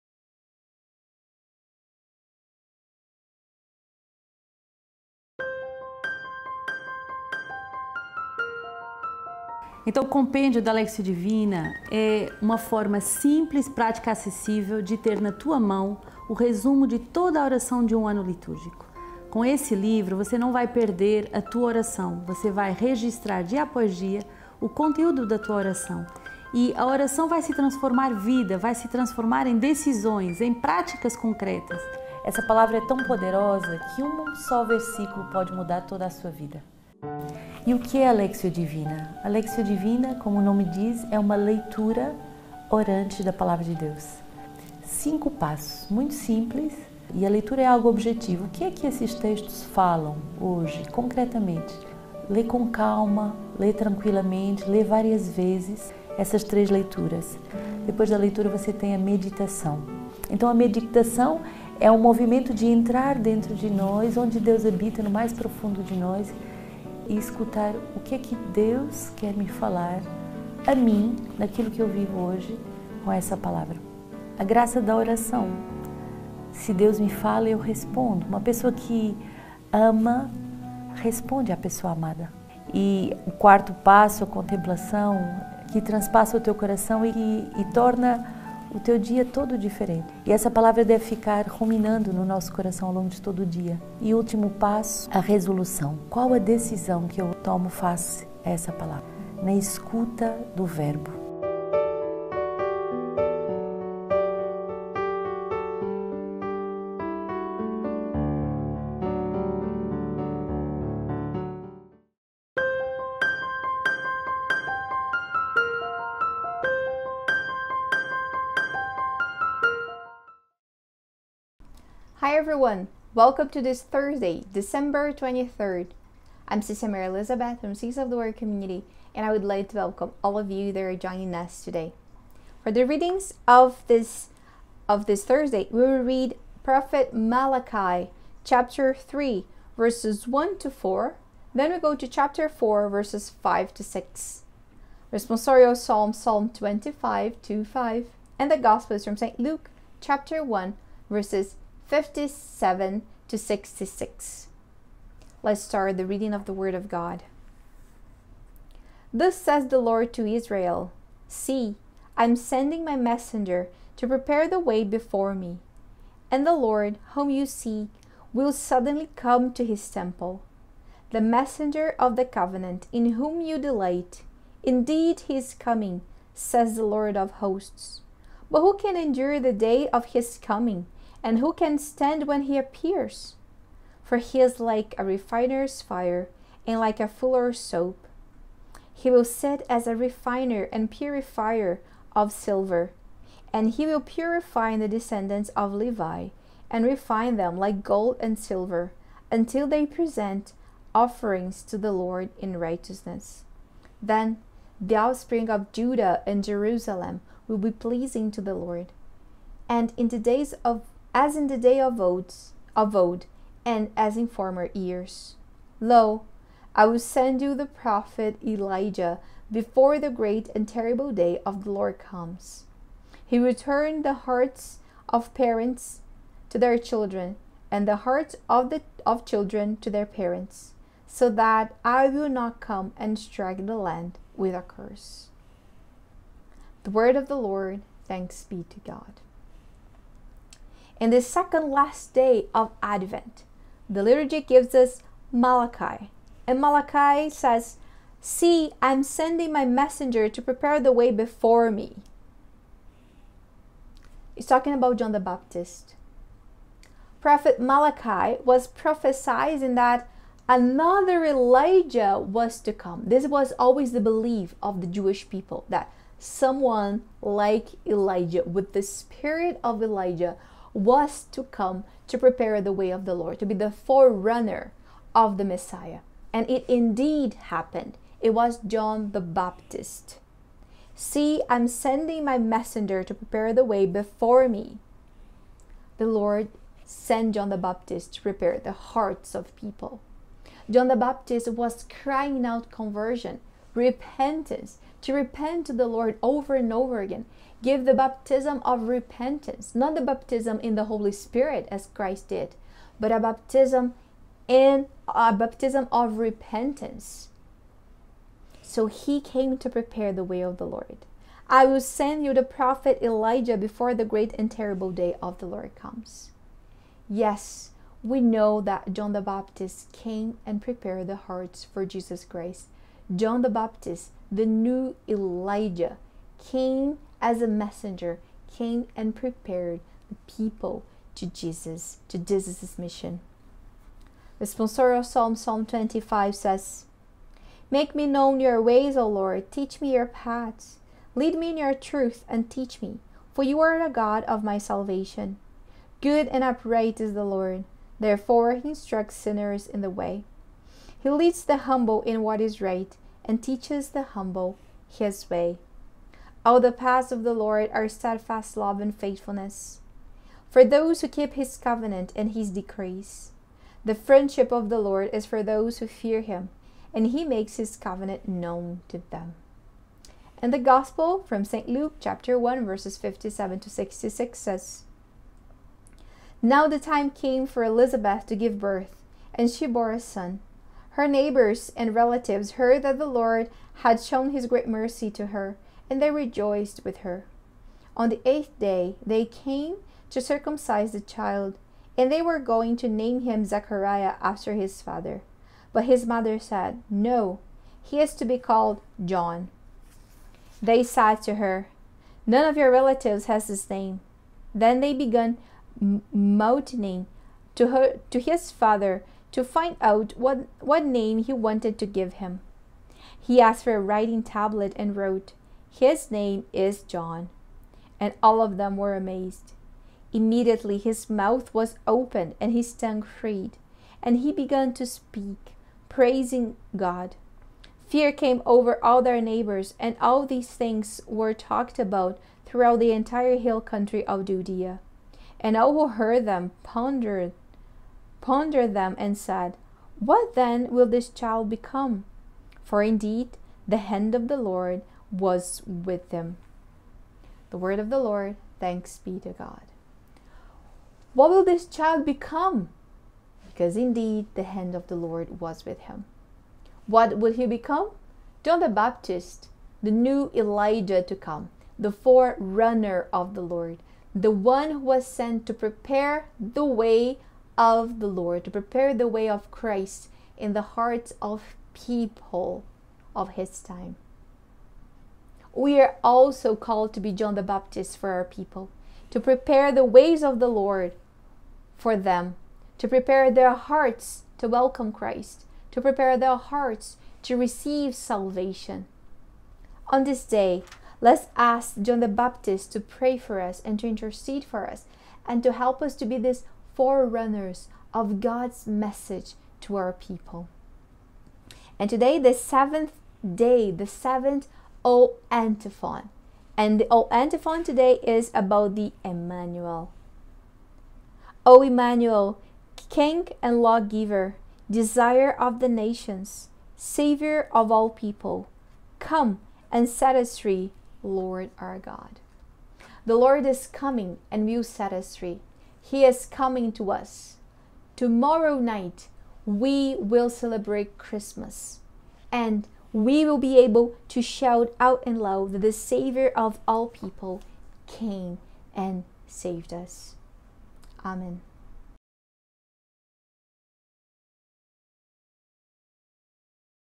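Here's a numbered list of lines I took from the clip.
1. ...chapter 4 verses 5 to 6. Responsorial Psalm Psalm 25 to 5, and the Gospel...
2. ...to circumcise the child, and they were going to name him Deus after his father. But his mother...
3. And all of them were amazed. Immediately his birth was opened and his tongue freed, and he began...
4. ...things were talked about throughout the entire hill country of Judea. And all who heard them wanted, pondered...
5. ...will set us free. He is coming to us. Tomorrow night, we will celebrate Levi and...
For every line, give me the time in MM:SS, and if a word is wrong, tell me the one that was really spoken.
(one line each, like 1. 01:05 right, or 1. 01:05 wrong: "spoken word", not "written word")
1. 02:22 right
2. 06:30 wrong: "Zechariah", not "Deus"
3. 06:57 wrong: "mouth", not "birth"
4. 07:10 wrong: "pondered", not "wanted"
5. 08:44 wrong: "Christmas", not "Levi".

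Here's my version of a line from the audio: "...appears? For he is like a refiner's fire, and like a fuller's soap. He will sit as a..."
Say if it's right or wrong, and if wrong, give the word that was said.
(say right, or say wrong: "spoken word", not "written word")
right.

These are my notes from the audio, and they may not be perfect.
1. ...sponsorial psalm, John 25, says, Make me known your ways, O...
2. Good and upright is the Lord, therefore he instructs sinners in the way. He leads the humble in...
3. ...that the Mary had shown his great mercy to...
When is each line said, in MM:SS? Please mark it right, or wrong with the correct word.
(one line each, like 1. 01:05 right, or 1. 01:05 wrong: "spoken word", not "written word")
1. 05:34 wrong: "Psalm", not "John"
2. 05:46 right
3. 06:22 wrong: "Lord", not "Mary".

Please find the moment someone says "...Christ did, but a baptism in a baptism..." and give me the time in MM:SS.
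05:01.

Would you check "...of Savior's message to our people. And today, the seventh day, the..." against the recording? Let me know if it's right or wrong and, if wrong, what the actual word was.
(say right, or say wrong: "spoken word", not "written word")
wrong: "God", not "Savior".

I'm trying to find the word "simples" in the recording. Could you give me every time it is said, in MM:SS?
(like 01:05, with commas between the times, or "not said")
00:12, 00:46.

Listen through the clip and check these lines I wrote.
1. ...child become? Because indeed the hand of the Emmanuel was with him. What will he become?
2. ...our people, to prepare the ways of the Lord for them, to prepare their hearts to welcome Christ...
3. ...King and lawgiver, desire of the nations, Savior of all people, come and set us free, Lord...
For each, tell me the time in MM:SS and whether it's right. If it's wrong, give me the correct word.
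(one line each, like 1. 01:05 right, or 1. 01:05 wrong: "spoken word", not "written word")
1. 07:31 wrong: "Lord", not "Emmanuel"
2. 07:58 right
3. 08:32 right.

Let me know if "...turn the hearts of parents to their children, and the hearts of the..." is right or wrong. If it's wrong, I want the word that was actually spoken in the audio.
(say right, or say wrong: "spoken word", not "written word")
right.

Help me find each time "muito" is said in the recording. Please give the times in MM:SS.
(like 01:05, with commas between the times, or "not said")
00:45.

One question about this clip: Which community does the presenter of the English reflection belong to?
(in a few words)
Seeds of the Word Community.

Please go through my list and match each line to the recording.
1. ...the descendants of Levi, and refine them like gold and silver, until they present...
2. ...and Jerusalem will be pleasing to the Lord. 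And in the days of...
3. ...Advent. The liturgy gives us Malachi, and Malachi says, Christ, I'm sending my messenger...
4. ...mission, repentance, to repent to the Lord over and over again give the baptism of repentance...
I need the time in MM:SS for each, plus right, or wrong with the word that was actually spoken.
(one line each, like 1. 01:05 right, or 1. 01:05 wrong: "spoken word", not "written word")
1. 03:14 right
2. 03:26 right
3. 04:02 wrong: "See", not "Christ"
4. 04:52 wrong: "conversion", not "mission".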